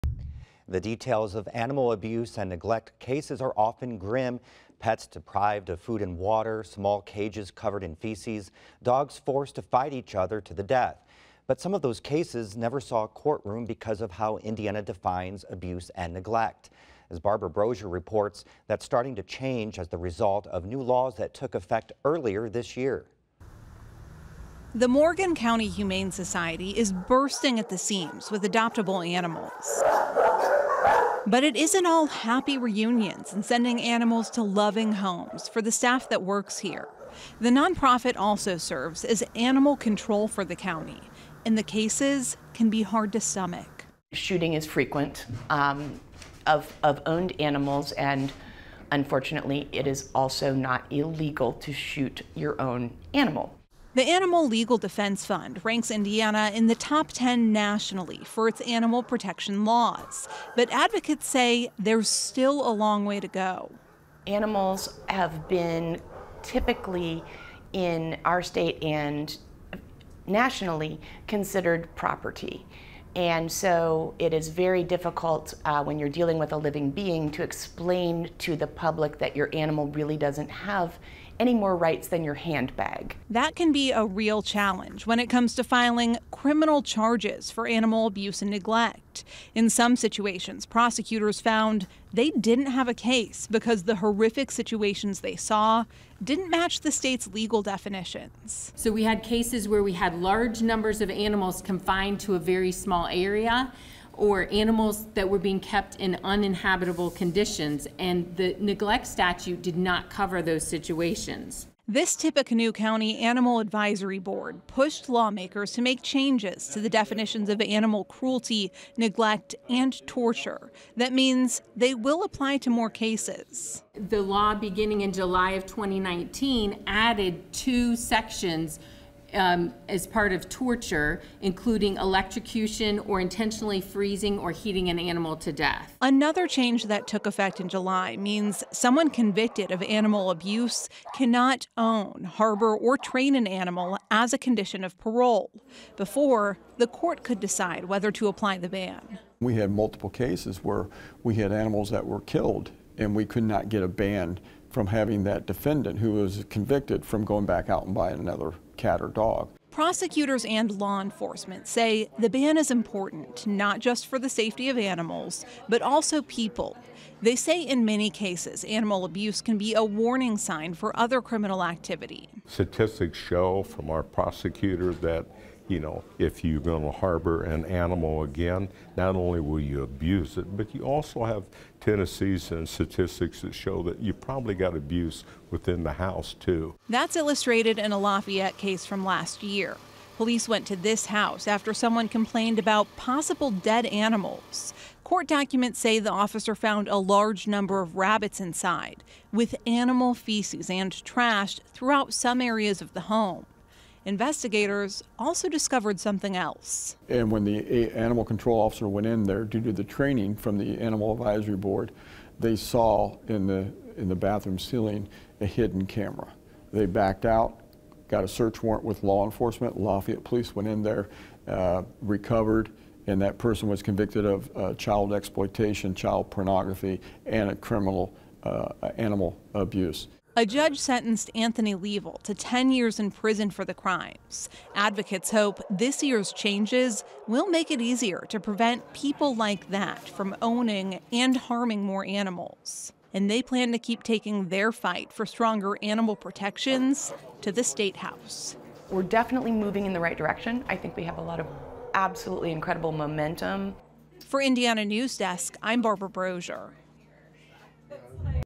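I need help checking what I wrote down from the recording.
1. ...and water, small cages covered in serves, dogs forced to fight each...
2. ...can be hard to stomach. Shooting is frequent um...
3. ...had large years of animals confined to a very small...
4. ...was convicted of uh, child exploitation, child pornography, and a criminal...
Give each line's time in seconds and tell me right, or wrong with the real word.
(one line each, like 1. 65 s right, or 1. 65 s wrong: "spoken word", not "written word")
1. 6 s wrong: "feces", not "serves"
2. 42 s right
3. 99 s wrong: "numbers", not "years"
4. 223 s right.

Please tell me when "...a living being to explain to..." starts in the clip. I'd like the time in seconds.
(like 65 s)
76 s.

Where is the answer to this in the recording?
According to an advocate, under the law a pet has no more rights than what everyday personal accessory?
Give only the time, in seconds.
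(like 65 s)
82 s.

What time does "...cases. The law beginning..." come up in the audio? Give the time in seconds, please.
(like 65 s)
122 s.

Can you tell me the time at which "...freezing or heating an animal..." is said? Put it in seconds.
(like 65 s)
133 s.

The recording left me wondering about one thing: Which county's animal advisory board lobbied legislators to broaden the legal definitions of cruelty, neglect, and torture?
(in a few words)
Tippecanoe County.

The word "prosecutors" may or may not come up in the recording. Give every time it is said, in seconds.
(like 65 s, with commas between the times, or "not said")
90 s, 159 s, 174 s.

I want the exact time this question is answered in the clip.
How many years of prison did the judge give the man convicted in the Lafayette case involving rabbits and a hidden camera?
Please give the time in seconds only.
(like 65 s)
232 s.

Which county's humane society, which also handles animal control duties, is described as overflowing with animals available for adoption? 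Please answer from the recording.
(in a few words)
Morgan County.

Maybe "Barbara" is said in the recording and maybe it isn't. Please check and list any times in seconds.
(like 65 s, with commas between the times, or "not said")
17 s, 255 s.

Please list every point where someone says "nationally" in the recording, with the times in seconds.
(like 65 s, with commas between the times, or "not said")
57 s, 70 s.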